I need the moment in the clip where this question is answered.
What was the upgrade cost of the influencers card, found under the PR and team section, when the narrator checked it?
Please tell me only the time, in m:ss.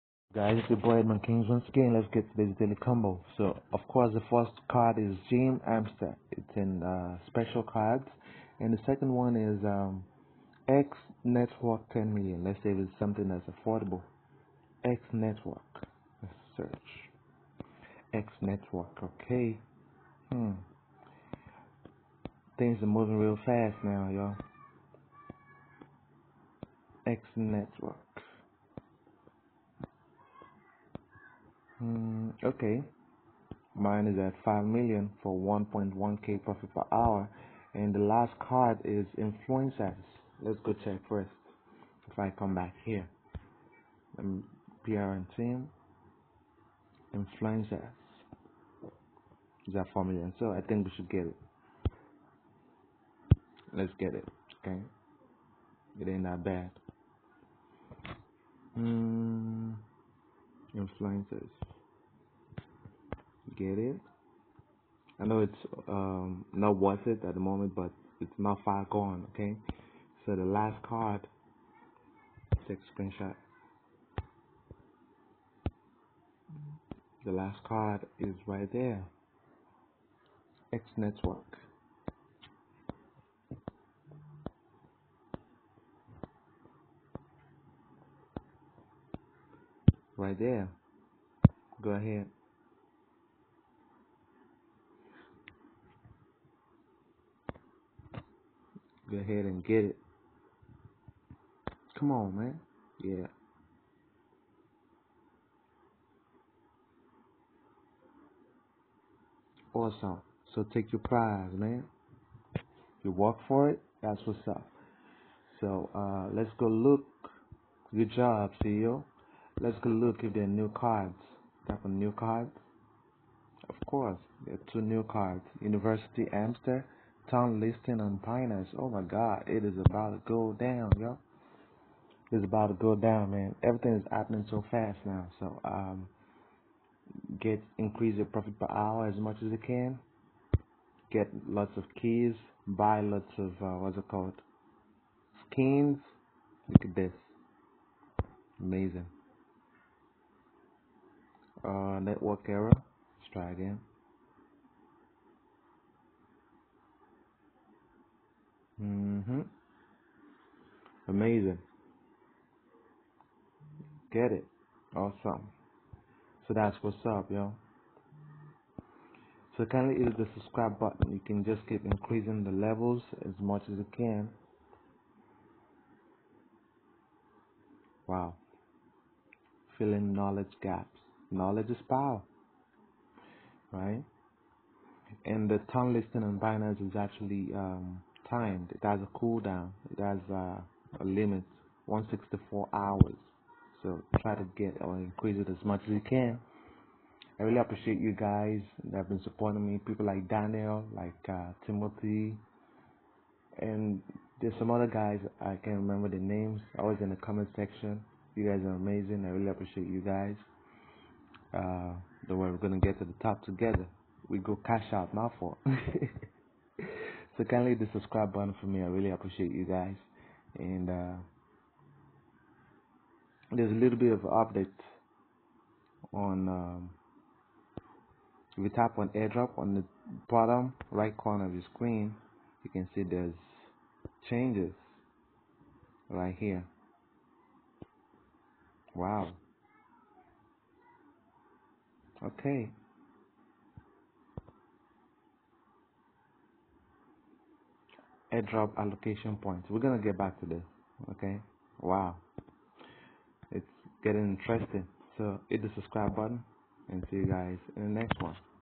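0:49.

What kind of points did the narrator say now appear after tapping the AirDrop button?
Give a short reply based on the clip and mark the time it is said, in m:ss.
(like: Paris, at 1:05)
airdrop allocation points, at 4:08.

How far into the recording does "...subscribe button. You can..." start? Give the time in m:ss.
2:50.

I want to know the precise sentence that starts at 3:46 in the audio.
Um, if you tap on AirDrop on the bottom right corner of your screen, you can see there's changes right here.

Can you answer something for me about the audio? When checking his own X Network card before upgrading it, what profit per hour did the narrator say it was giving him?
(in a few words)
1.1k.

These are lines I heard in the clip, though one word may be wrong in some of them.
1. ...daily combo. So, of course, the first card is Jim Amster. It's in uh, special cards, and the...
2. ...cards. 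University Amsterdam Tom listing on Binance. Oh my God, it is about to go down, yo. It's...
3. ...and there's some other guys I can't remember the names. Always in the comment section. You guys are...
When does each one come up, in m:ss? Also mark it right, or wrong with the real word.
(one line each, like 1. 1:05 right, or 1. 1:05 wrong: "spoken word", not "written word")
1. 0:02 right
2. 2:05 right
3. 3:23 right.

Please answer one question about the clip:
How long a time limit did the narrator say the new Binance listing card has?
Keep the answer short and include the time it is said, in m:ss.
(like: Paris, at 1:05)
164 hours, at 3:11.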